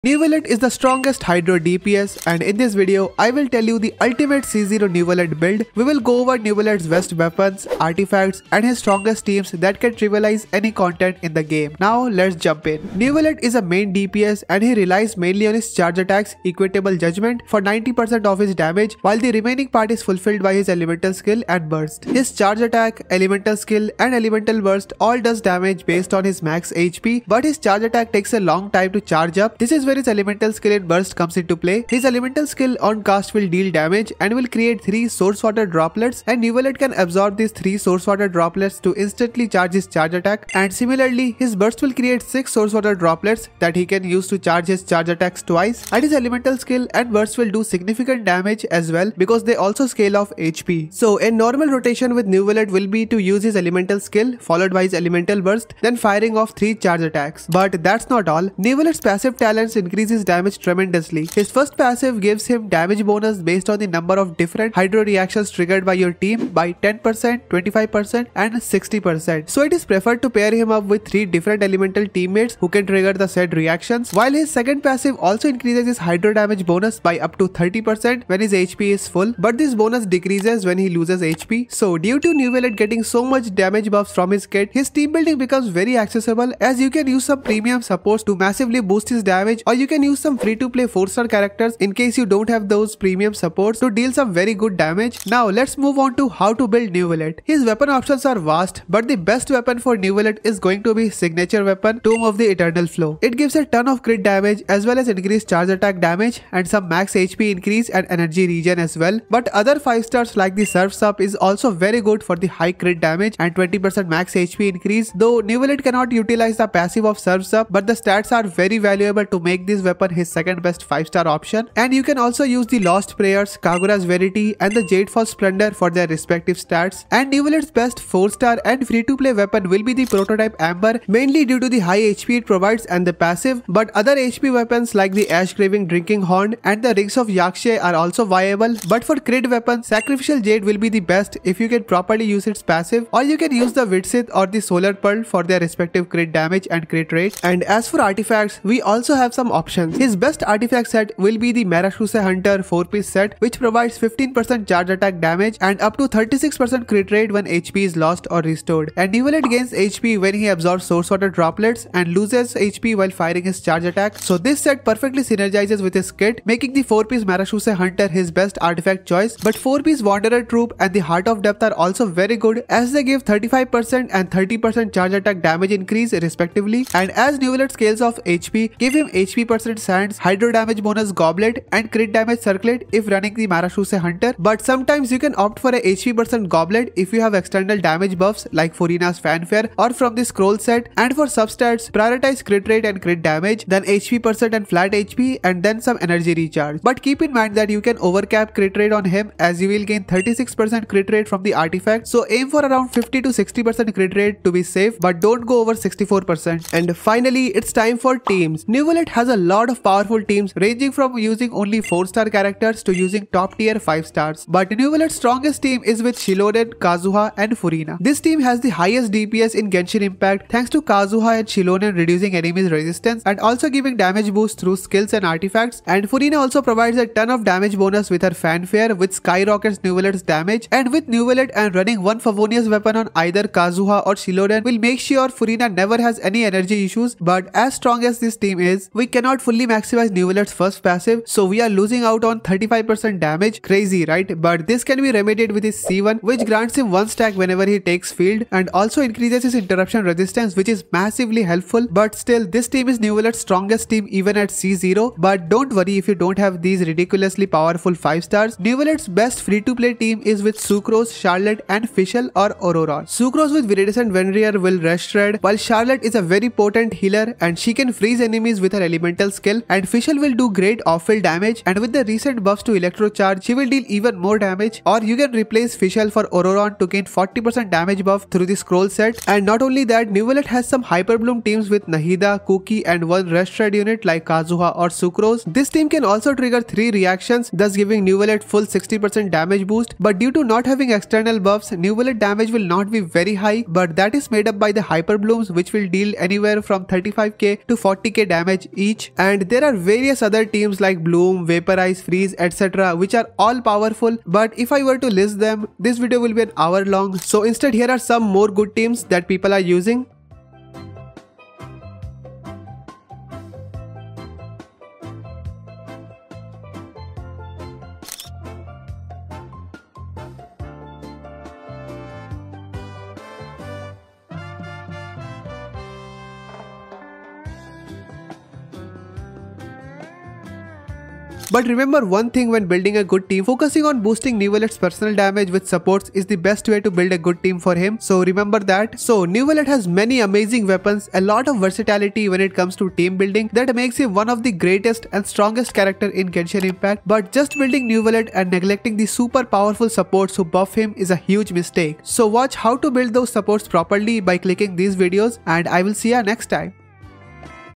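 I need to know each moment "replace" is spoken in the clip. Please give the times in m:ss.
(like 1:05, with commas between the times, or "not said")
4:35.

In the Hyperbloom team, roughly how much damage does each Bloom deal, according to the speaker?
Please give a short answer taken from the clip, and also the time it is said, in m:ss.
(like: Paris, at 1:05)
35k to 40k, at 4:56.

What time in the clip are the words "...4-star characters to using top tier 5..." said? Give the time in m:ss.
3:31.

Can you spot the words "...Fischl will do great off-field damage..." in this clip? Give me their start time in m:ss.
4:29.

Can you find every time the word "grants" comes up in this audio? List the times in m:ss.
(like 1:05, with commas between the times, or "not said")
4:06.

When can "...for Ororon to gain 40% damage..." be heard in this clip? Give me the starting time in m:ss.
4:36.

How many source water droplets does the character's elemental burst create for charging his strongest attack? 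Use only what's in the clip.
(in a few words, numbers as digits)
6.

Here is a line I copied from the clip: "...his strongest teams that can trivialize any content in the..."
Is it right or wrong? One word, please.
right.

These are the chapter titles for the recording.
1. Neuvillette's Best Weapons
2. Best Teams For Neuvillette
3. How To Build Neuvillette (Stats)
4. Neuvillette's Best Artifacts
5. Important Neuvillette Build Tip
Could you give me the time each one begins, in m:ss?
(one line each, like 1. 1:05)
1. 1:35
2. 3:26
3. 2:56
4. 2:26
5. 3:16.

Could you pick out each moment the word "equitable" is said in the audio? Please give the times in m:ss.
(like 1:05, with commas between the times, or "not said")
0:16.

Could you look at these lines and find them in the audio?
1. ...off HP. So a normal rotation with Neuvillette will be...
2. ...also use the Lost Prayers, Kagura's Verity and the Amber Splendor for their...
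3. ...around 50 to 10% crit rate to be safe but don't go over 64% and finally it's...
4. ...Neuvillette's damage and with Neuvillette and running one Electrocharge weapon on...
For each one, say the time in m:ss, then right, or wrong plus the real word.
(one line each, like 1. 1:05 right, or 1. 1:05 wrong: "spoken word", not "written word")
1. 0:50 right
2. 2:02 wrong: "Jadefall", not "Amber"
3. 3:22 wrong: "60", not "10"
4. 3:49 wrong: "Favonius", not "Electrocharge".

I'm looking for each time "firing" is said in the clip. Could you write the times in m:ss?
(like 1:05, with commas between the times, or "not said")
0:56, 2:43.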